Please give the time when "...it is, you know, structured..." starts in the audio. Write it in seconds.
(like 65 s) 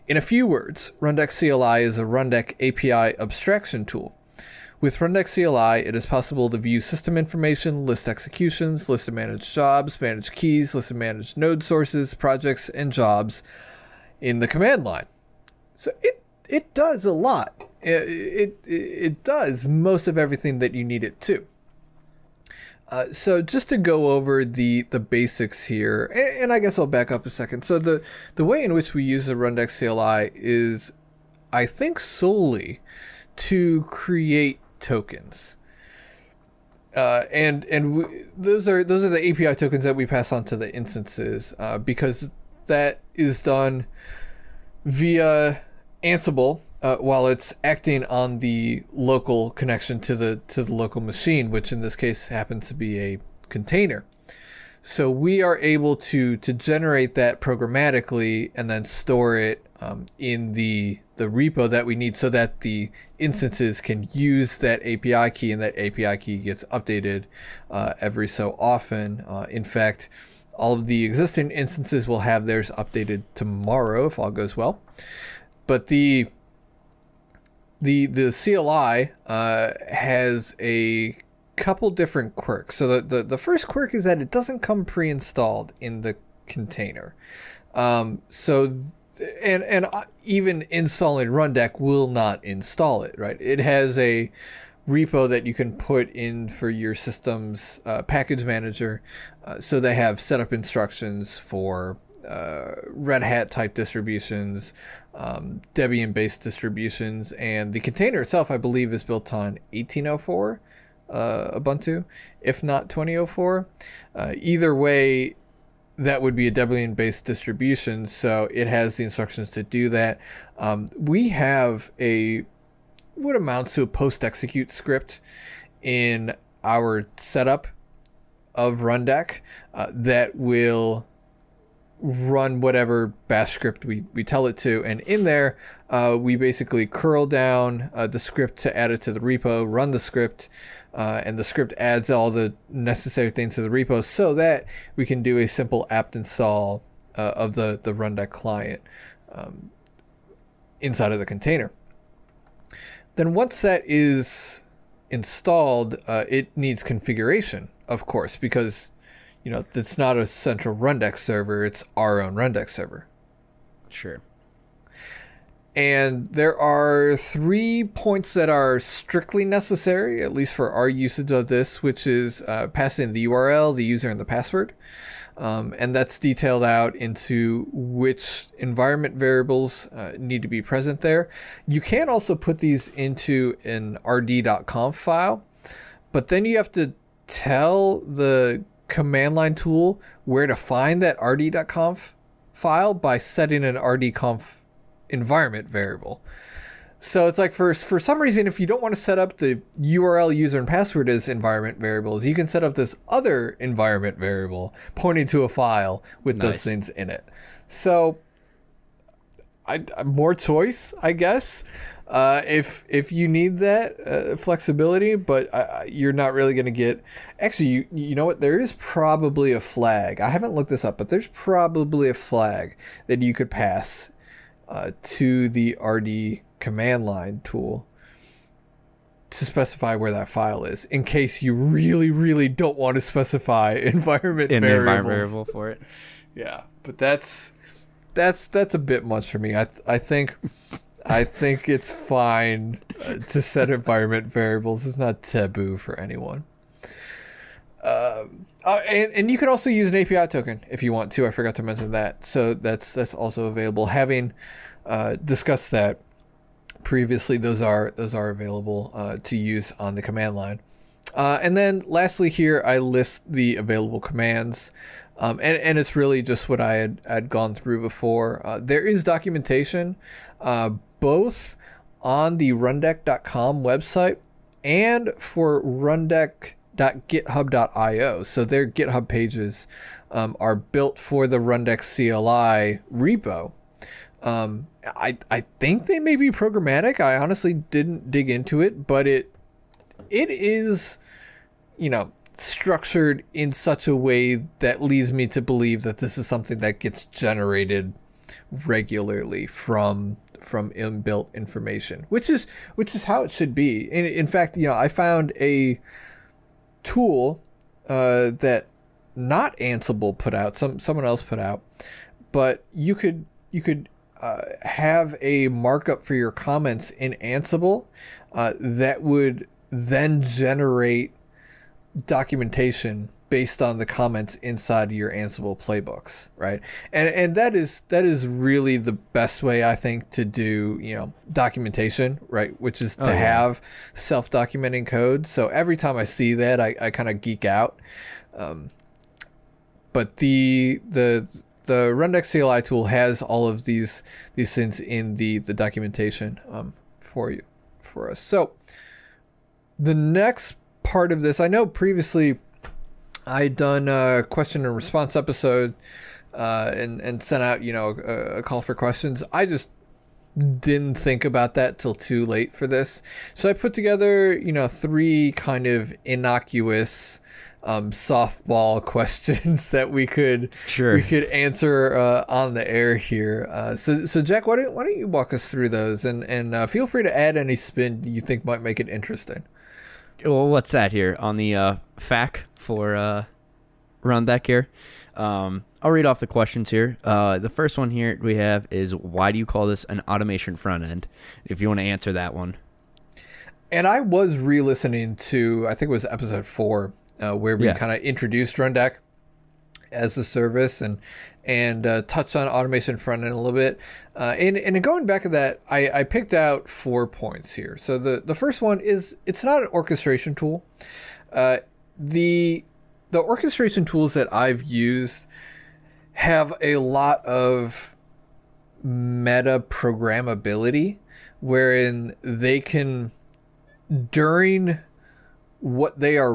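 290 s.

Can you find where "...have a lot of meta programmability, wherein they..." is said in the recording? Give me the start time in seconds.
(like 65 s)
416 s.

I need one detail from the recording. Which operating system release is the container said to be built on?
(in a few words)
Ubuntu 18.04.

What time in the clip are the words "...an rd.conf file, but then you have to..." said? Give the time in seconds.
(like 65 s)
183 s.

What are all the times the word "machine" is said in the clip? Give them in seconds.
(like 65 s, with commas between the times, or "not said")
50 s.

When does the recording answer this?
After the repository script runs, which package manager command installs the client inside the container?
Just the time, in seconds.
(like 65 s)
145 s.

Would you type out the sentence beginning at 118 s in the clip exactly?
So it has the instructions to do that.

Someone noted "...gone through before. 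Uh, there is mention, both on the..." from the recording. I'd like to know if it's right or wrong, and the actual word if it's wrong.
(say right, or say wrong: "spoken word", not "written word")
wrong: "documentation", not "mention".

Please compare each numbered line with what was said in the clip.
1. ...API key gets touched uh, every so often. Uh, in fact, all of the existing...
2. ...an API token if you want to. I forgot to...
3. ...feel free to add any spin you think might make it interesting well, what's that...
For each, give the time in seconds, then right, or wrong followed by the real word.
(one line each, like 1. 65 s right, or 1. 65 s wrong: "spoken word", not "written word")
1. 65 s wrong: "updated", not "touched"
2. 249 s right
3. 376 s right.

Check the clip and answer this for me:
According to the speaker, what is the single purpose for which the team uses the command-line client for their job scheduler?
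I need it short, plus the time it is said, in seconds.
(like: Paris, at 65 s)
To create tokens, at 31 s.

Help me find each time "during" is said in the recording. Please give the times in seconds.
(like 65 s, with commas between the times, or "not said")
424 s.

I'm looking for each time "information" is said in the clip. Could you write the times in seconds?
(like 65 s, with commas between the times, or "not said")
7 s, 301 s.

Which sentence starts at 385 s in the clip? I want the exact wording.
Um, I'll read off the questions here.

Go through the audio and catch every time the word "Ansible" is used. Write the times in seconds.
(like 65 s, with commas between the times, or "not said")
46 s, 309 s, 317 s, 325 s.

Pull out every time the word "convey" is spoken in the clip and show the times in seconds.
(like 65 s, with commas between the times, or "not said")
not said.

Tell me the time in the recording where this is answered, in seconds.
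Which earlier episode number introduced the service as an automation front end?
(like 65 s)
396 s.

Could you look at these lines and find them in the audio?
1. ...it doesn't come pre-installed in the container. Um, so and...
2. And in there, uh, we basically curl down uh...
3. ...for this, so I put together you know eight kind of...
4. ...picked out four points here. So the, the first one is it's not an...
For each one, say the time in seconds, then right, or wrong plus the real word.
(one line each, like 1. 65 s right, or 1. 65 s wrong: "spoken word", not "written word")
1. 84 s right
2. 134 s right
3. 362 s wrong: "three", not "eight"
4. 406 s right.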